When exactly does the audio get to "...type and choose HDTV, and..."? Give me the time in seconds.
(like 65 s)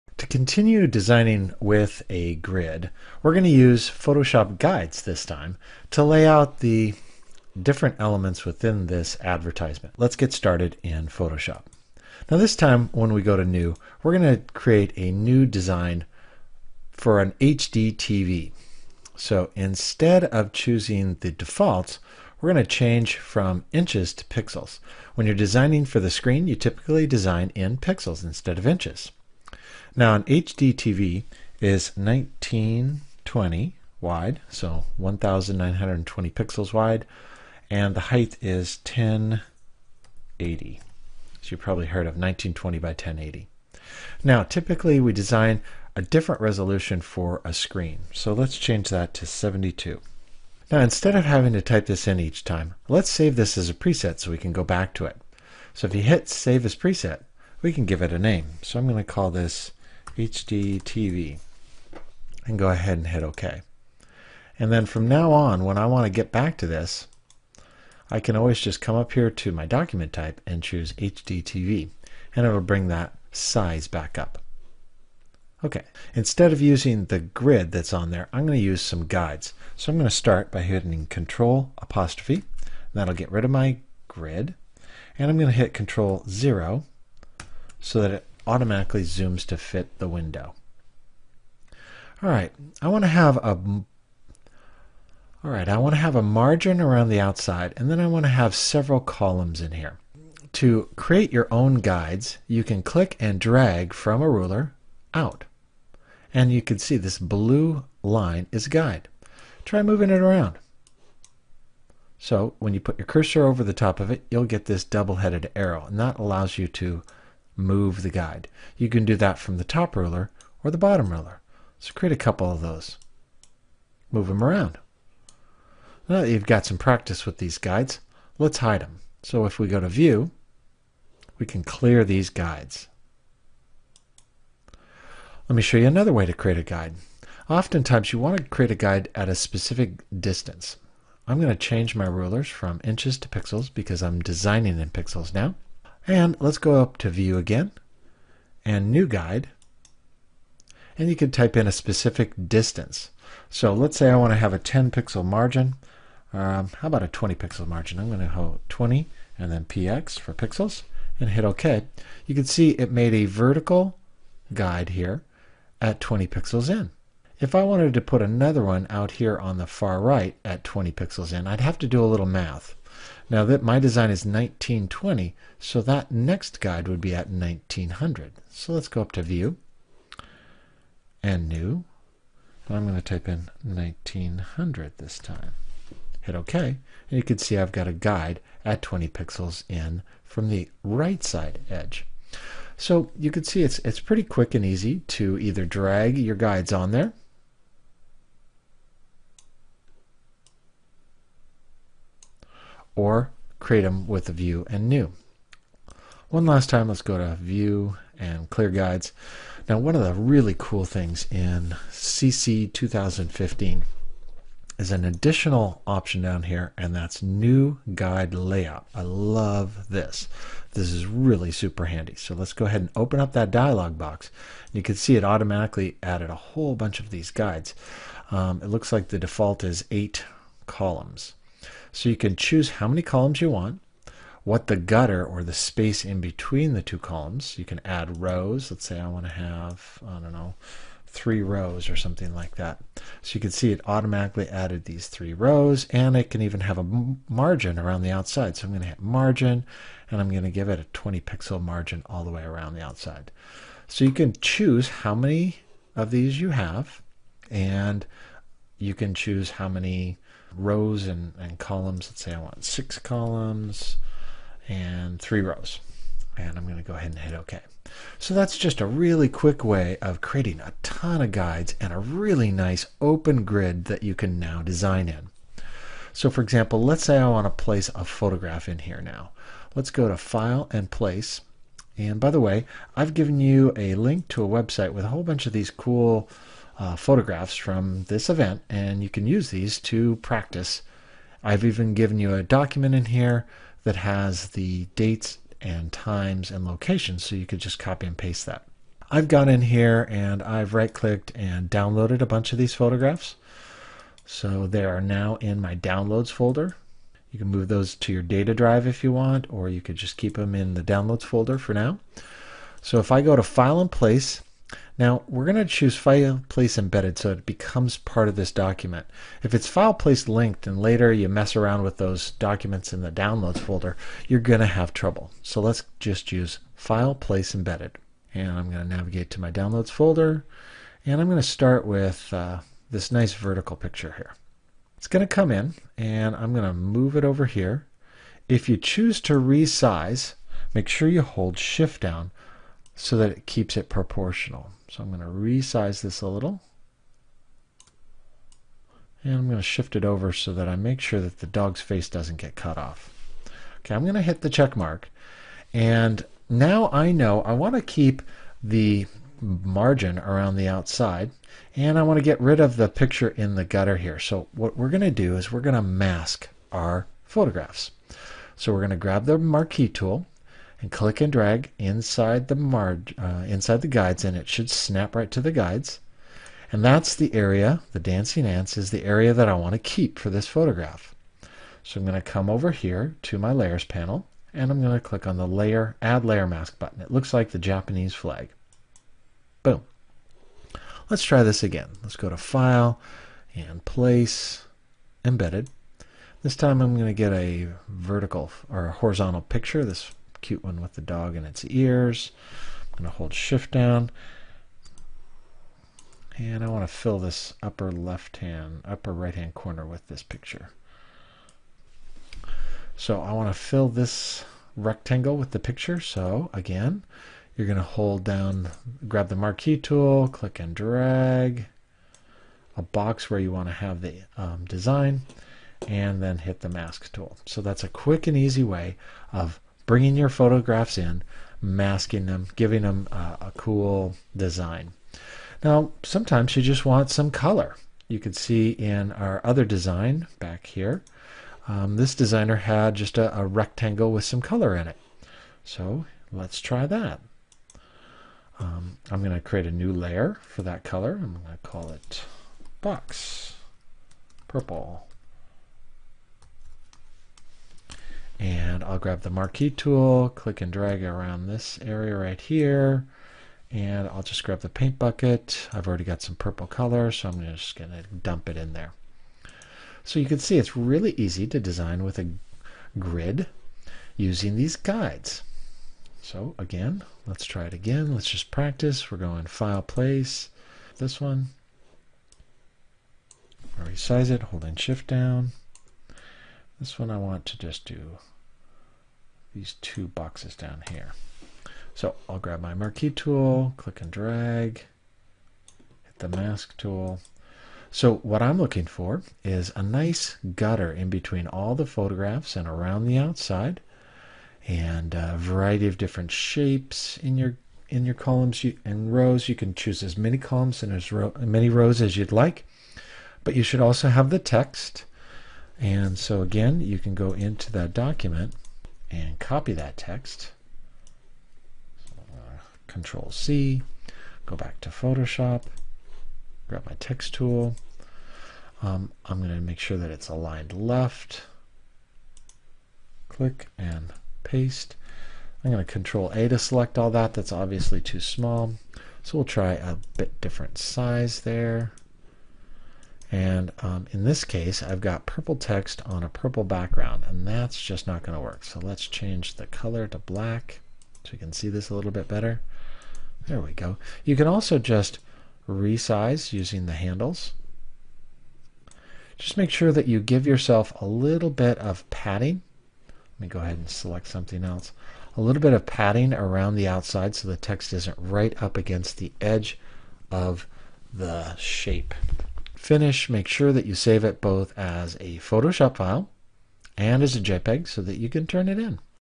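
70 s.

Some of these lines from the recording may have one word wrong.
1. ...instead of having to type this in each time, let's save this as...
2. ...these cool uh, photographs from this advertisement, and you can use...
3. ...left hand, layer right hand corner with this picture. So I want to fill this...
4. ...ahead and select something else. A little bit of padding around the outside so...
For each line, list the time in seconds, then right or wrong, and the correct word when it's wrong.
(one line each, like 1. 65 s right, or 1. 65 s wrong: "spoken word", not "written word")
1. 50 s right
2. 285 s wrong: "event", not "advertisement"
3. 407 s wrong: "upper", not "layer"
4. 563 s right.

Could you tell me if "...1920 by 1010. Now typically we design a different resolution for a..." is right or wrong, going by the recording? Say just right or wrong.
wrong.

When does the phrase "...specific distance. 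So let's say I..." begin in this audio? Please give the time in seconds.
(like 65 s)
151 s.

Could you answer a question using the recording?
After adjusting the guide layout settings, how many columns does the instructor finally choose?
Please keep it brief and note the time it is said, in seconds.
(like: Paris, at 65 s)
6, at 262 s.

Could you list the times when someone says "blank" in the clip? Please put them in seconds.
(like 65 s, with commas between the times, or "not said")
not said.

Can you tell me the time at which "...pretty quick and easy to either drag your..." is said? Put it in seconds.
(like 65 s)
194 s.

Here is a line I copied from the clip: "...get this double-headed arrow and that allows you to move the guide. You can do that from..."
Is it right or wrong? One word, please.
right.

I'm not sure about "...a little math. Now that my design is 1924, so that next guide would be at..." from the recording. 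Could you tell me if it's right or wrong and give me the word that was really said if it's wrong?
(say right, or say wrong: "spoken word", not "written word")
wrong: "1920", not "1924".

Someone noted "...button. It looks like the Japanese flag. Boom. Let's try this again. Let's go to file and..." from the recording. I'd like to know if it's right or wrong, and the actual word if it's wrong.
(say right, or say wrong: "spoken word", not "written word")
right.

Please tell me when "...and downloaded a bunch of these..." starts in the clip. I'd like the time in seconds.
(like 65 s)
301 s.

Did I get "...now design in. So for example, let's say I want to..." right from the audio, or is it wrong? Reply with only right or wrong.
right.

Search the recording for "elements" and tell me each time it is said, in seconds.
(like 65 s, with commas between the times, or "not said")
7 s.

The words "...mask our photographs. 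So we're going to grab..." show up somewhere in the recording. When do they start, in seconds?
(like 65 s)
365 s.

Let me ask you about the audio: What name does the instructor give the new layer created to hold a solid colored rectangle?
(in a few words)
box purple.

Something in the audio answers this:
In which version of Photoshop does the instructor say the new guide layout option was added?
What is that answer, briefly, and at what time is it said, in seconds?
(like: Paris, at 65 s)
CC 2015, at 211 s.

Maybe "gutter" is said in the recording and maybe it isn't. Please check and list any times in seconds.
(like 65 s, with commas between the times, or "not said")
234 s, 363 s, 500 s.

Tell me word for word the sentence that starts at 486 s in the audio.
This one I want to just do these two boxes down here.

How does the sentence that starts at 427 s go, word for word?
So that's a quick and easy way of bringing your photographs in, masking them, giving them a cool design.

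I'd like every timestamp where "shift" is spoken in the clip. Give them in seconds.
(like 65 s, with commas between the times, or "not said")
341 s, 349 s, 403 s, 484 s.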